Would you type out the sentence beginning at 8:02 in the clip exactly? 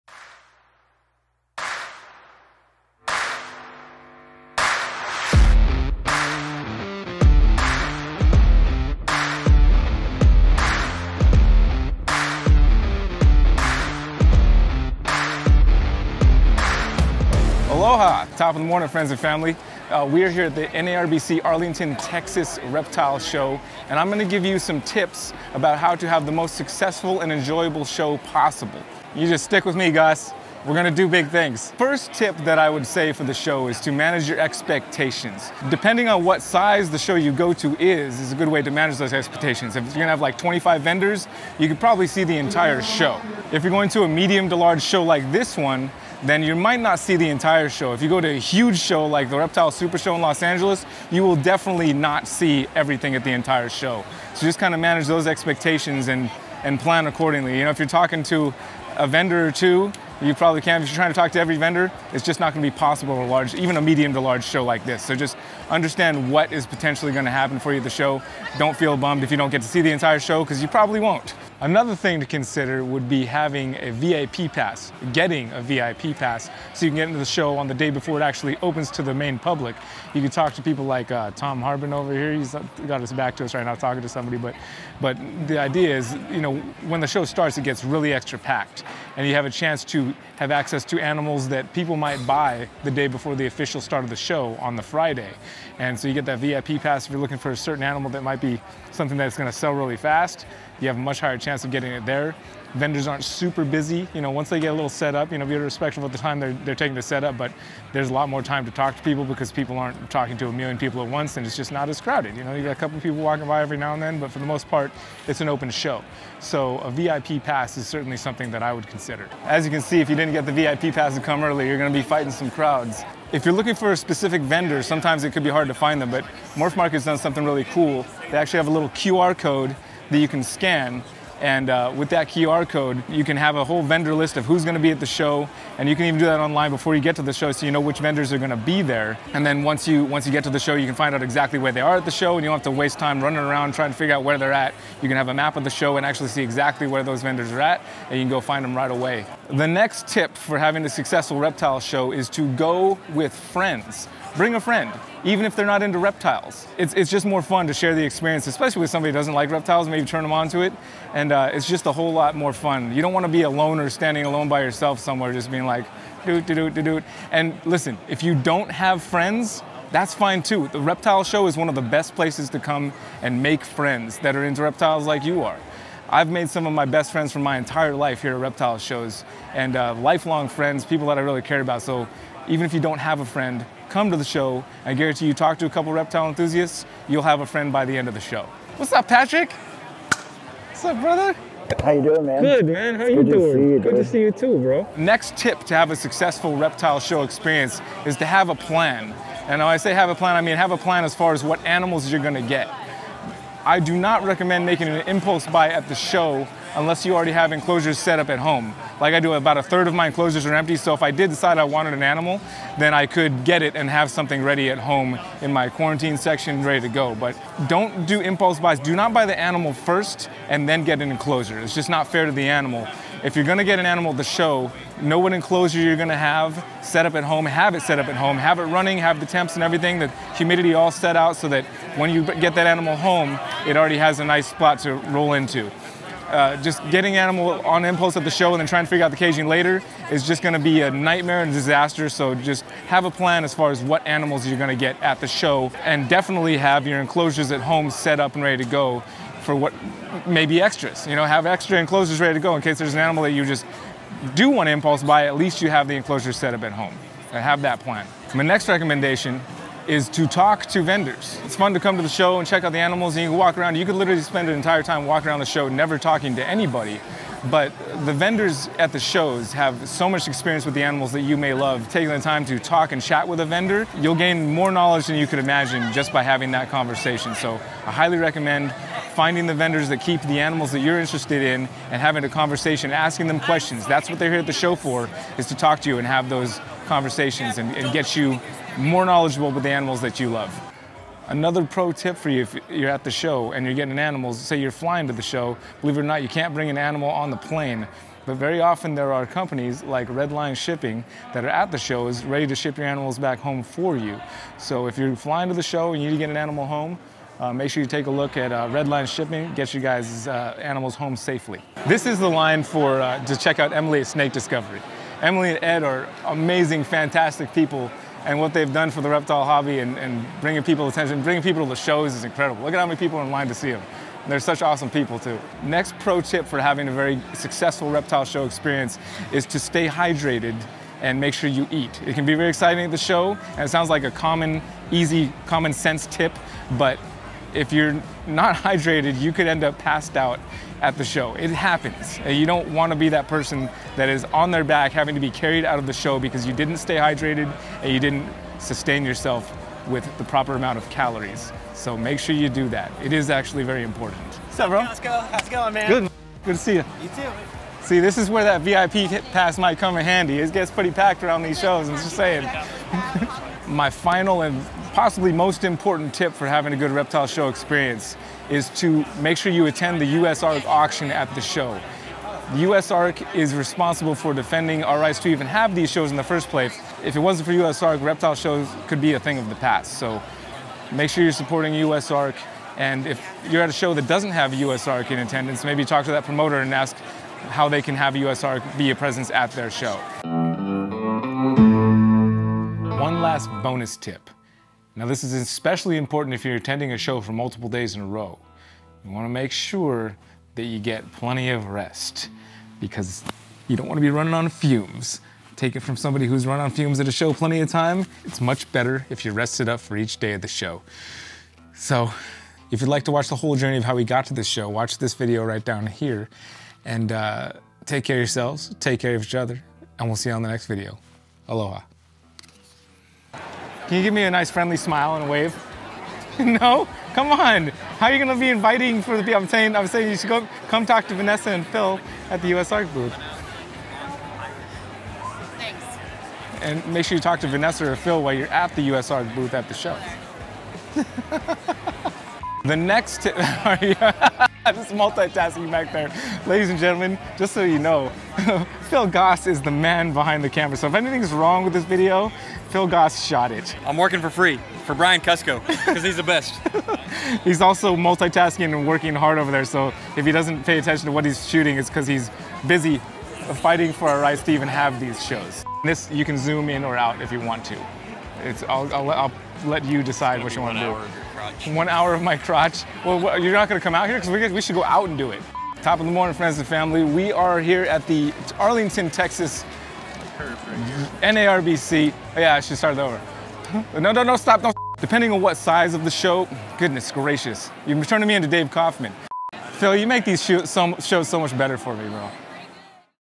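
Oh, yeah, I should start over.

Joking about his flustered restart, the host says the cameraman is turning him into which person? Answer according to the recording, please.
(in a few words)
Dave Kaufman.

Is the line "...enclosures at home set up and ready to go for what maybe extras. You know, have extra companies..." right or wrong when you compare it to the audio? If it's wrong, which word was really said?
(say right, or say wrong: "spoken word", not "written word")
wrong: "enclosures", not "companies".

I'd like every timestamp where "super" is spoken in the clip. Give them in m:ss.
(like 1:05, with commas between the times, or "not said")
0:49, 1:43.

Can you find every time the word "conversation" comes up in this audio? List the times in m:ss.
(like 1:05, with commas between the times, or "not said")
4:36, 4:42, 4:46.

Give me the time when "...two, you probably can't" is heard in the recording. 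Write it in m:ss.
0:59.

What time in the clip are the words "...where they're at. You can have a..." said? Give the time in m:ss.
2:24.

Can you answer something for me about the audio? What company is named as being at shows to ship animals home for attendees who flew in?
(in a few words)
Red Line Shipping.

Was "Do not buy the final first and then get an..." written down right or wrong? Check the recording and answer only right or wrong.
wrong.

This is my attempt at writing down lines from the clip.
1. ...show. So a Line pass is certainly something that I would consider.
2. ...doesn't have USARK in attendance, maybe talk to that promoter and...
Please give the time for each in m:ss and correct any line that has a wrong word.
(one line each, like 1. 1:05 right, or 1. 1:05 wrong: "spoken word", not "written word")
1. 1:55 wrong: "VIP", not "Line"
2. 6:24 right.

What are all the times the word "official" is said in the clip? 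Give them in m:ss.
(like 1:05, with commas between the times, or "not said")
1:33.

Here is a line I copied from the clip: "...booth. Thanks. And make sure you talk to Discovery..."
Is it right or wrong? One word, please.
wrong.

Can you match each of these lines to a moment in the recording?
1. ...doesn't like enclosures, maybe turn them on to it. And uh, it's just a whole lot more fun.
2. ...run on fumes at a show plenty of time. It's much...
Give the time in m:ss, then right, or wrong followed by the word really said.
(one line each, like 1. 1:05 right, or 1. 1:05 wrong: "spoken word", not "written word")
1. 2:39 wrong: "reptiles", not "enclosures"
2. 6:46 right.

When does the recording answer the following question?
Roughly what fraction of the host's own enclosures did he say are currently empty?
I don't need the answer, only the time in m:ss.
3:29.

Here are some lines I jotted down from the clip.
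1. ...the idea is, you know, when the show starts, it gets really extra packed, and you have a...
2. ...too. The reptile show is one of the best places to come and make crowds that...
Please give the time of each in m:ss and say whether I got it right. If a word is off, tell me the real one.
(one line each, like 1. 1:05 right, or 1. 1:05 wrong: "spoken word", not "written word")
1. 1:25 right
2. 2:50 wrong: "friends", not "crowds".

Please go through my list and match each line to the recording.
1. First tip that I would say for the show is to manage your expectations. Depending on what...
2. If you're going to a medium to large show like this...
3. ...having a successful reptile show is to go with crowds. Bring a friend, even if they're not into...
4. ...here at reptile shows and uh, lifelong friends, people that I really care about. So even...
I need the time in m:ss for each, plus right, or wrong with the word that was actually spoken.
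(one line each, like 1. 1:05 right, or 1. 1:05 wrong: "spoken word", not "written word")
1. 0:31 right
2. 0:43 right
3. 2:30 wrong: "friends", not "crowds"
4. 2:58 right.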